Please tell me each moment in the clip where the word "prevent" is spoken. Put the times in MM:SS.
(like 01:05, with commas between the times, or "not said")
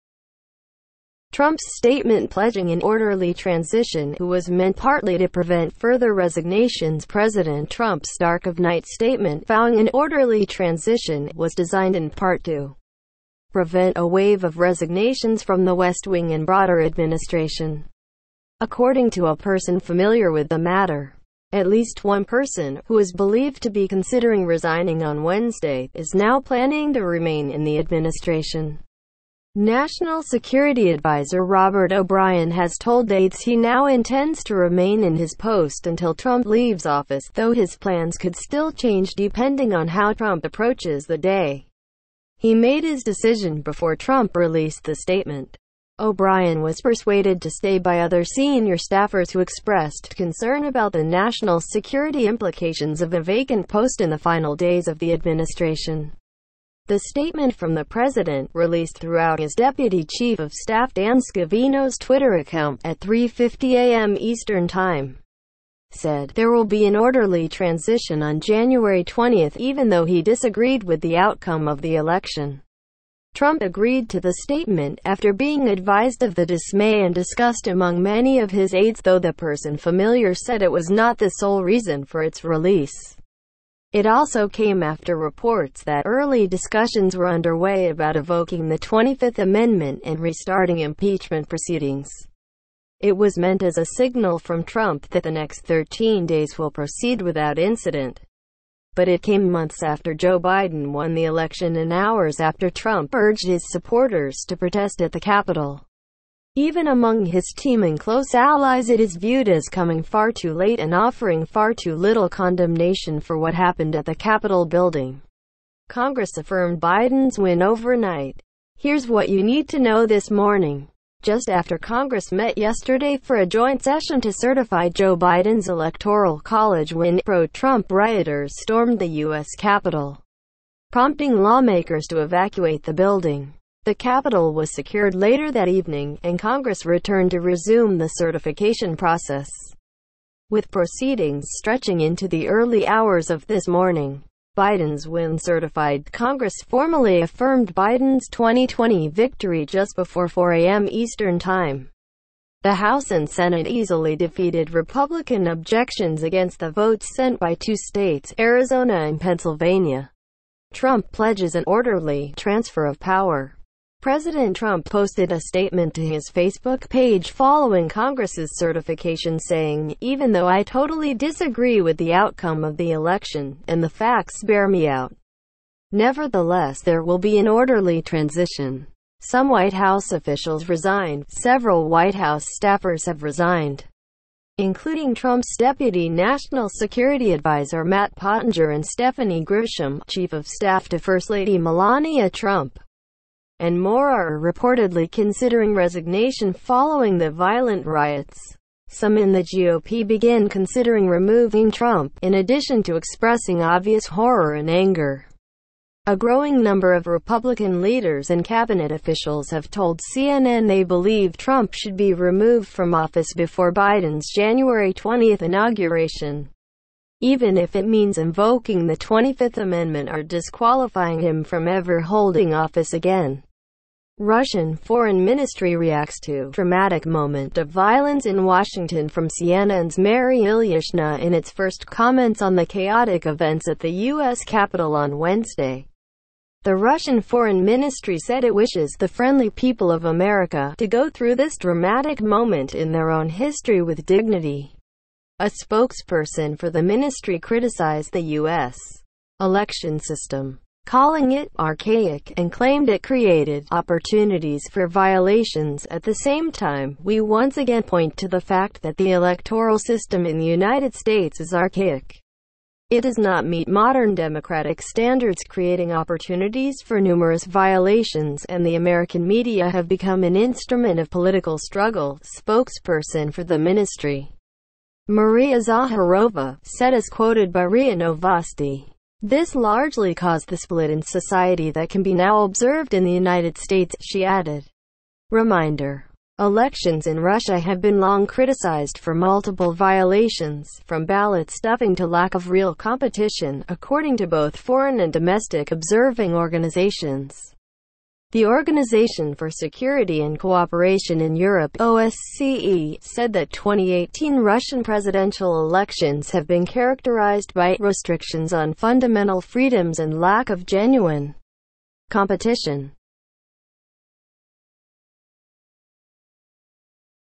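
00:05, 00:13.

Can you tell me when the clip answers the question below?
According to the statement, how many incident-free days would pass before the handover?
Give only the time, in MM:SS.
01:35.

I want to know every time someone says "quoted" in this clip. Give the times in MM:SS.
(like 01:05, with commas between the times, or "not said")
04:37.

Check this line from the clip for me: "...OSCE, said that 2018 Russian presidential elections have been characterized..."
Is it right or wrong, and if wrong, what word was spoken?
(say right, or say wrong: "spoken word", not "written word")
right.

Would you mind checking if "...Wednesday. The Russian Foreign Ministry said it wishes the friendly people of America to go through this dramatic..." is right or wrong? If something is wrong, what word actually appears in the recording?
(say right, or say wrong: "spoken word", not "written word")
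right.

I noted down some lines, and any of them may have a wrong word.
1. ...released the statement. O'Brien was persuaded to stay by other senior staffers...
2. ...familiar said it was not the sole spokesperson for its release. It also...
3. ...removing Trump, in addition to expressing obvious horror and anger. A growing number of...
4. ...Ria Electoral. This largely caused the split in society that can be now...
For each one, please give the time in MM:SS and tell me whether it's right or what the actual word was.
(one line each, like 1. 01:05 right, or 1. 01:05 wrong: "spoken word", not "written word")
1. 00:44 right
2. 01:19 wrong: "reason", not "spokesperson"
3. 03:21 right
4. 04:37 wrong: "Novosti", not "Electoral".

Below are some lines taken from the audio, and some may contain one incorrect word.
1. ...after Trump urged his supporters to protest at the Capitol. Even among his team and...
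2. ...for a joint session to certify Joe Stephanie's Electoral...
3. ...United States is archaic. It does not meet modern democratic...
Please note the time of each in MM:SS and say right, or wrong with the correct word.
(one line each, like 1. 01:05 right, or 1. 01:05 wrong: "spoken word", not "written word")
1. 01:42 right
2. 02:03 wrong: "Biden", not "Stephanie"
3. 04:20 right.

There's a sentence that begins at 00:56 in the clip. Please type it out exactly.
The statement from the president, released throughout his deputy chief of staff Dan Scavino's Twitter account at 3.50 a.m.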